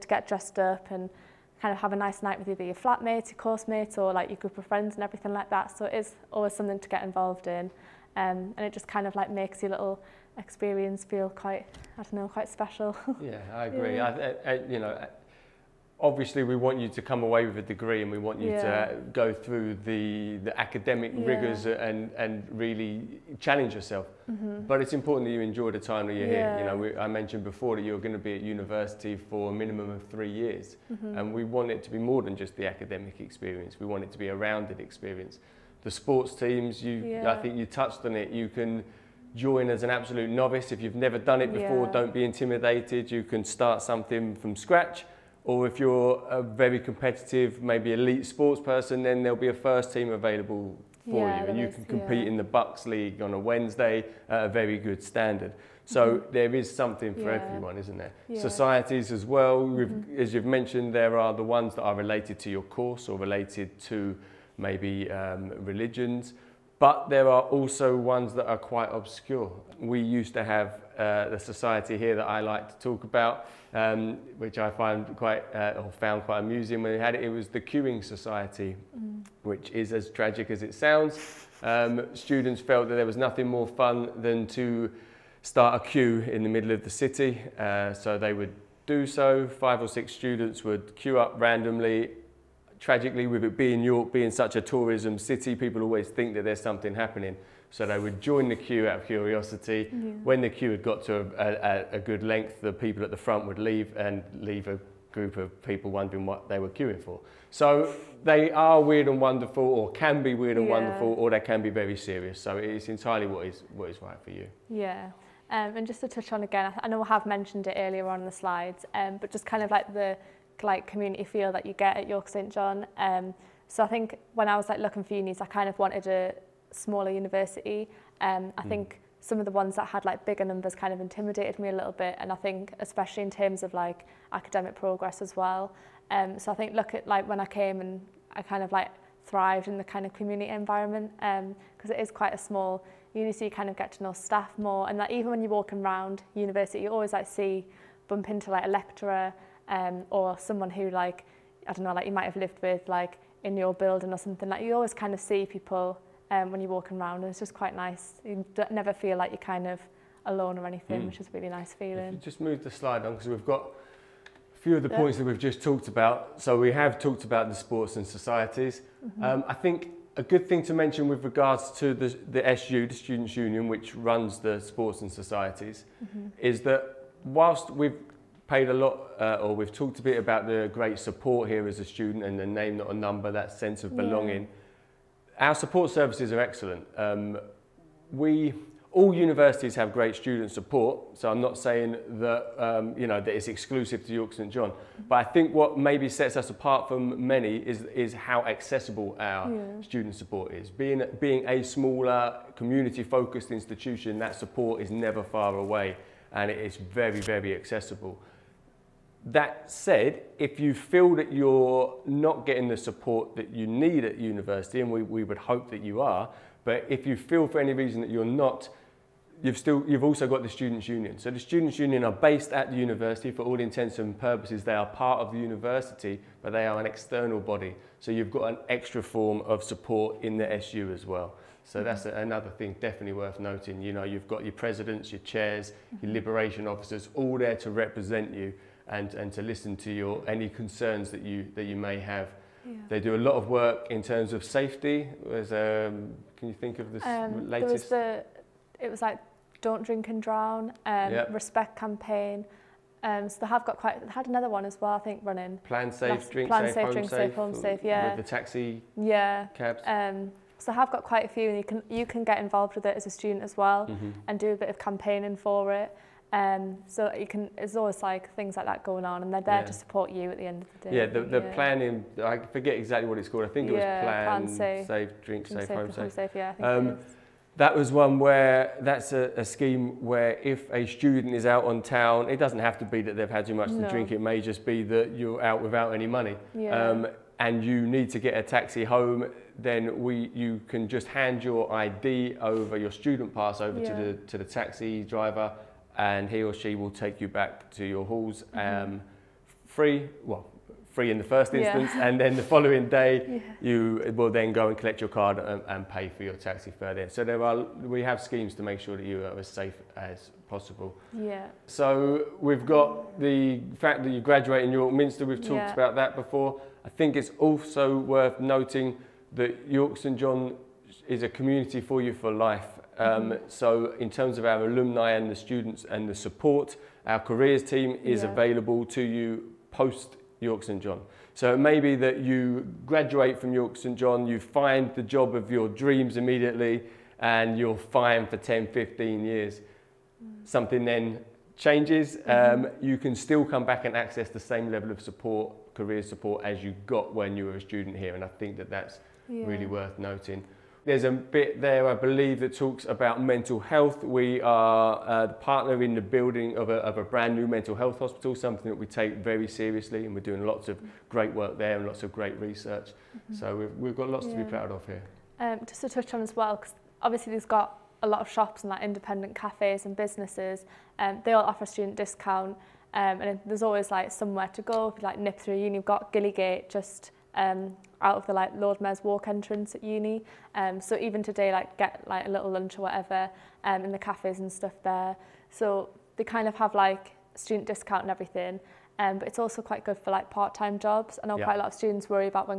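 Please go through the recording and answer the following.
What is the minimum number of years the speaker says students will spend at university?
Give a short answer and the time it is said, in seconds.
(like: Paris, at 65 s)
3, at 30 s.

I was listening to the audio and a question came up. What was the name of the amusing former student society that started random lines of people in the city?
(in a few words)
queuing society.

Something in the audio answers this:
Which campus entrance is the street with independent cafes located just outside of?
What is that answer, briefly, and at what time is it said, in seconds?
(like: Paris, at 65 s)
Lord Mayor's Walk, at 378 s.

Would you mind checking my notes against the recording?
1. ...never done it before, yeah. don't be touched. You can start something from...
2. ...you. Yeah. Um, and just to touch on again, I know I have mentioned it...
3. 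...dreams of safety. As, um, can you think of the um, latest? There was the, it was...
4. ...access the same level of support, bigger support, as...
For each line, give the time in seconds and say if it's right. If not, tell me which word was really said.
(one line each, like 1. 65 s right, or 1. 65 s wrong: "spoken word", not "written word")
1. 40 s wrong: "intimidated", not "touched"
2. 114 s right
3. 244 s wrong: "terms", not "dreams"
4. 343 s wrong: "career", not "bigger".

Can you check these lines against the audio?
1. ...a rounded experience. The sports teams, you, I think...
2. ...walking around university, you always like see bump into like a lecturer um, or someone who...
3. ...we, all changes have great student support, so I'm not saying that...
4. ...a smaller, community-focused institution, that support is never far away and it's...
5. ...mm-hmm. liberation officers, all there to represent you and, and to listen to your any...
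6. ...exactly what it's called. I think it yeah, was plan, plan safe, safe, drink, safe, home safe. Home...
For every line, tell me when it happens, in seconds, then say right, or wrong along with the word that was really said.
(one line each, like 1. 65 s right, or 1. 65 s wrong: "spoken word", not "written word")
1. 34 s right
2. 145 s right
3. 188 s wrong: "universities", not "changes"
4. 201 s right
5. 236 s right
6. 272 s right.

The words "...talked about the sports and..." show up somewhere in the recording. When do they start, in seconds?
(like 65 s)
166 s.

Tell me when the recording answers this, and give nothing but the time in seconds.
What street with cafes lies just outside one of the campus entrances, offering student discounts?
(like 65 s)
376 s.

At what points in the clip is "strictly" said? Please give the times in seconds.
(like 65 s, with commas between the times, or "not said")
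not said.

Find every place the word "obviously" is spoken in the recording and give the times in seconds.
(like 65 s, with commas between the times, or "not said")
16 s, 367 s.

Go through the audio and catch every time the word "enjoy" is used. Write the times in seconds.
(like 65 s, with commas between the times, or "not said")
25 s.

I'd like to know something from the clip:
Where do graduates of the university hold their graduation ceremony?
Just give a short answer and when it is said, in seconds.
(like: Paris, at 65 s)
York Minster, at 314 s.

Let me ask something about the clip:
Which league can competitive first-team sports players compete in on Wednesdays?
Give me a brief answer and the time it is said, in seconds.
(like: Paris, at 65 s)
BUCS League, at 52 s.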